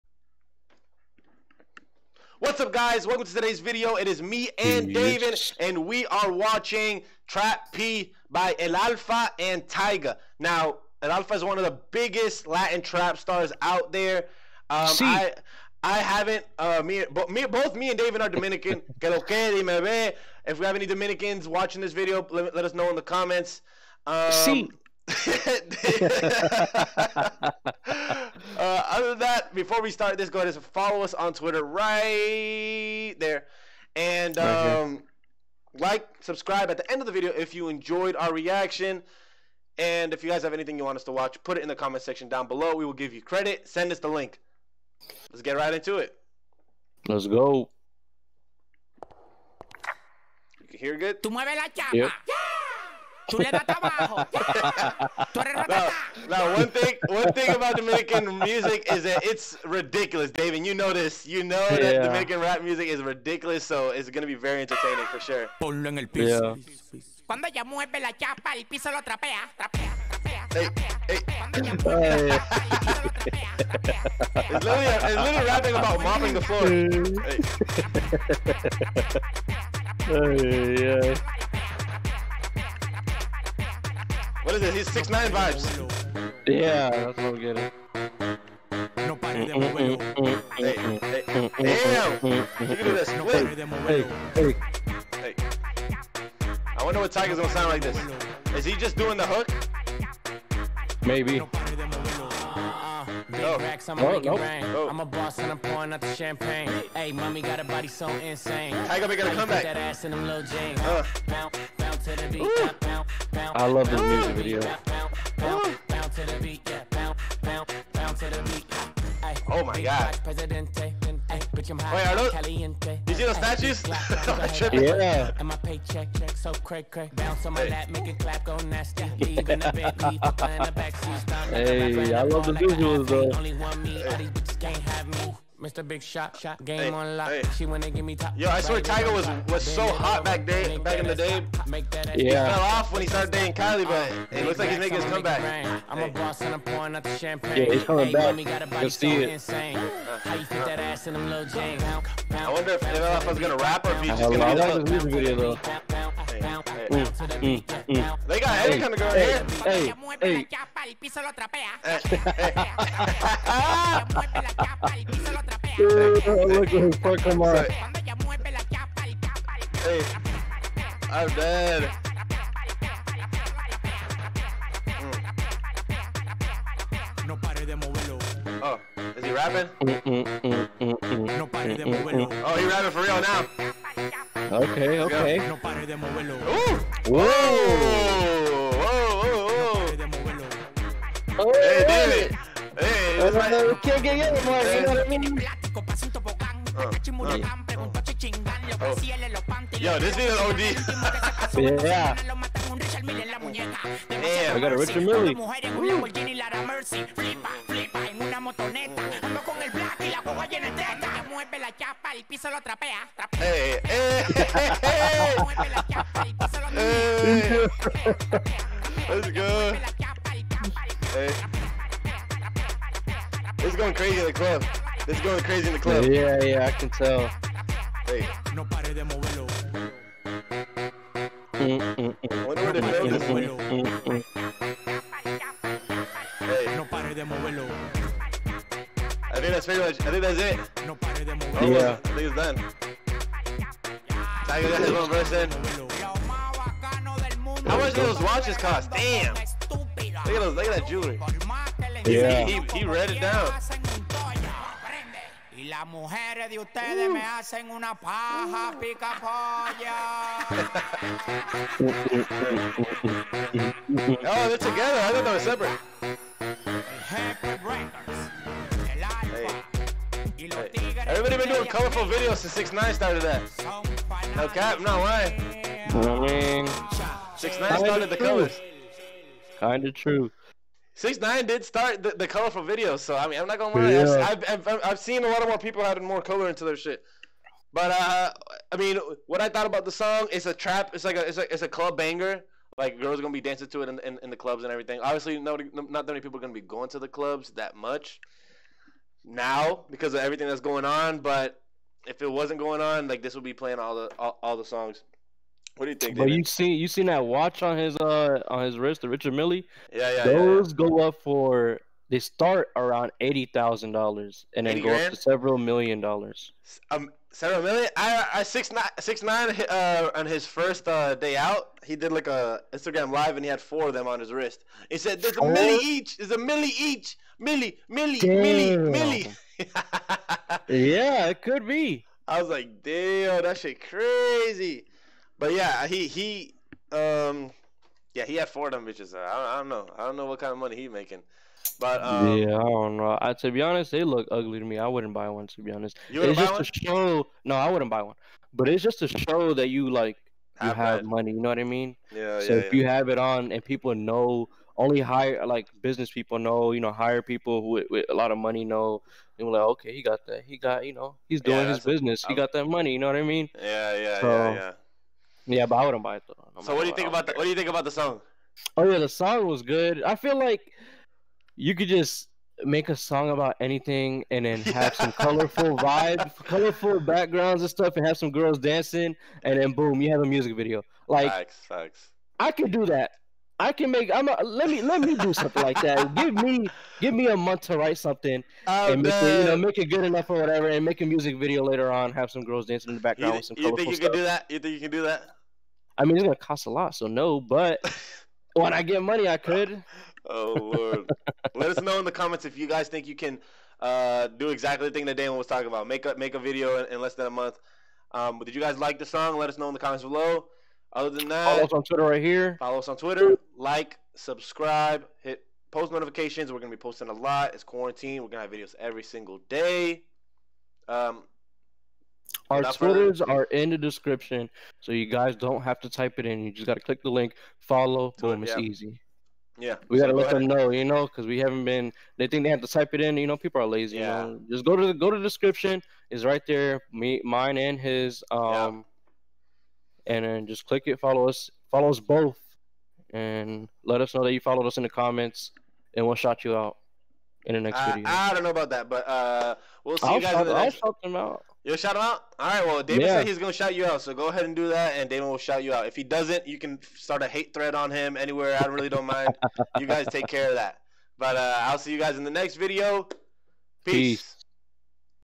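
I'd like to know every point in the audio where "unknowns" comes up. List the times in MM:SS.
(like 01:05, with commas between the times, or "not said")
not said.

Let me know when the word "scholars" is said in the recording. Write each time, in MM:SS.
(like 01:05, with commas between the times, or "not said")
not said.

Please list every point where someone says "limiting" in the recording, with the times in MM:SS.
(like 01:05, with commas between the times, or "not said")
not said.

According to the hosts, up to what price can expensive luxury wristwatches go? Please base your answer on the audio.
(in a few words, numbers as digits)
several million dollars.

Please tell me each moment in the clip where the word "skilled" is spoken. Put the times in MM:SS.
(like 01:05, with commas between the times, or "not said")
not said.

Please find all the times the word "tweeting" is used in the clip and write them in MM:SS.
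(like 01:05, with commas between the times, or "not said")
not said.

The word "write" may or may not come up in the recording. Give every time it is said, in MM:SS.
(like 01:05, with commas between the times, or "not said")
06:27.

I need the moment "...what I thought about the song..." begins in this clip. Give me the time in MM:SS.
04:49.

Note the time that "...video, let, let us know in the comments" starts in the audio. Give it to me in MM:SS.
00:21.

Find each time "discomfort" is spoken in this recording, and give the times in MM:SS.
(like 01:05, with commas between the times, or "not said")
not said.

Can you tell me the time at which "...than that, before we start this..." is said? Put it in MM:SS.
00:29.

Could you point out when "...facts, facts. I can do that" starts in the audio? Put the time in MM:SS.
06:21.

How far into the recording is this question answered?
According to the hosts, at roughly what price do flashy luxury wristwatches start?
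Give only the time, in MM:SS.
05:13.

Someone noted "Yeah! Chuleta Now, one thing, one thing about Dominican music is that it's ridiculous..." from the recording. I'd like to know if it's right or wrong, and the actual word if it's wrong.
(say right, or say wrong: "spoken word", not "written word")
right.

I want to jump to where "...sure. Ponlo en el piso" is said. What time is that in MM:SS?
01:05.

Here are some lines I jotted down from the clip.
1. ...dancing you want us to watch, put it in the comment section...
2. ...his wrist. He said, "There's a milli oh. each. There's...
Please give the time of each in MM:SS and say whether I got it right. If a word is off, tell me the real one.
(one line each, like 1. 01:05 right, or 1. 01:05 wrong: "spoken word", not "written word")
1. 00:40 wrong: "anything", not "dancing"
2. 05:24 right.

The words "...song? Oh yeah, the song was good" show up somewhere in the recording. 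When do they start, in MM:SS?
06:07.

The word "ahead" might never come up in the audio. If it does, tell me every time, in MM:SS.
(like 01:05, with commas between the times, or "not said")
00:30, 07:10, 07:34.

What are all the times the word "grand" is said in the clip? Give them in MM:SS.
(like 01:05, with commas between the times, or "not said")
05:14.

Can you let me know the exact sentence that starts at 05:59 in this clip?
And we're like, okay, he got that.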